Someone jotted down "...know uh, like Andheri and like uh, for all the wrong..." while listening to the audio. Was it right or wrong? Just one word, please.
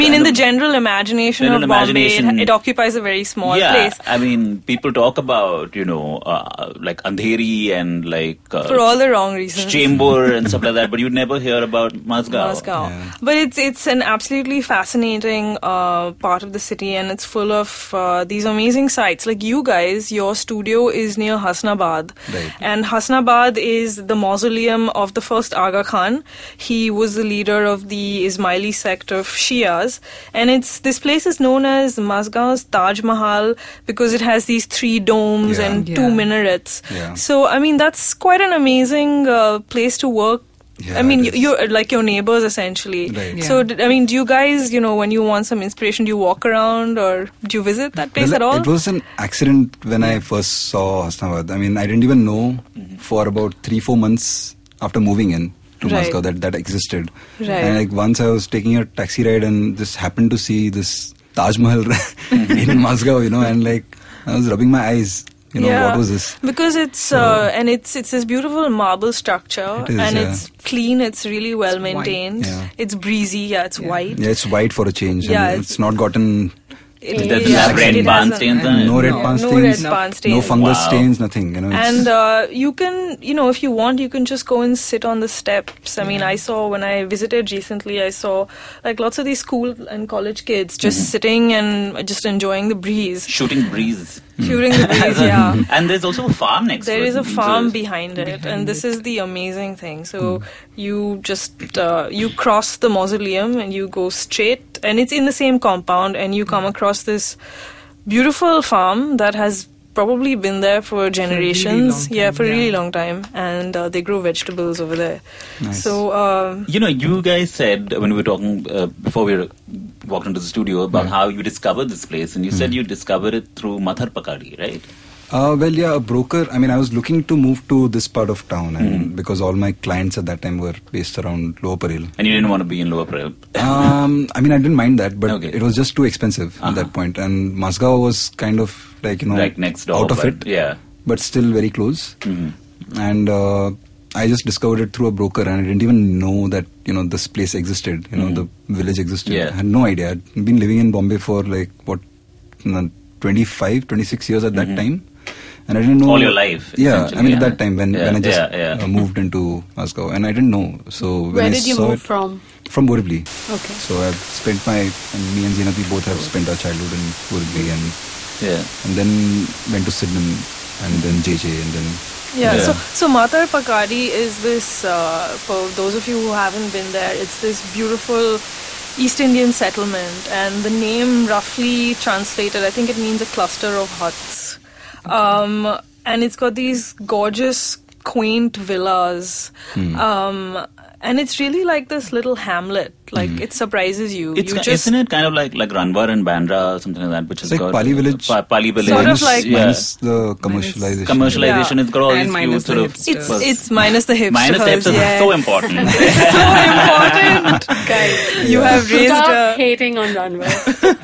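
right.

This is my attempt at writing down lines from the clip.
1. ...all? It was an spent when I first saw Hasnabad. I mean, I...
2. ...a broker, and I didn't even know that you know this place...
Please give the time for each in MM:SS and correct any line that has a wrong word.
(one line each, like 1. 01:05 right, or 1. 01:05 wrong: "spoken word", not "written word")
1. 00:48 wrong: "accident", not "spent"
2. 02:25 right.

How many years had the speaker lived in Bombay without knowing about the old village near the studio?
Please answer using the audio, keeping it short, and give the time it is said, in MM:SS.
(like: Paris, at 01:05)
25 or 26, at 02:33.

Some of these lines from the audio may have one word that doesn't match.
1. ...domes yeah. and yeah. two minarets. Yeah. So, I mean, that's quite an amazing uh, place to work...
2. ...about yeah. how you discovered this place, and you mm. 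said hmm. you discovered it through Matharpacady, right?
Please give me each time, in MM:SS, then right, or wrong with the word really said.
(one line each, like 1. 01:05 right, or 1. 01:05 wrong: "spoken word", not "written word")
1. 00:34 right
2. 02:00 right.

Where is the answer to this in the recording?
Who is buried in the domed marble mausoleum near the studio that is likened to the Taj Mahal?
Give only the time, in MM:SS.
00:25.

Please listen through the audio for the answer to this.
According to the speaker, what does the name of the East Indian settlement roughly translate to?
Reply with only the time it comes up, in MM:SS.
03:03.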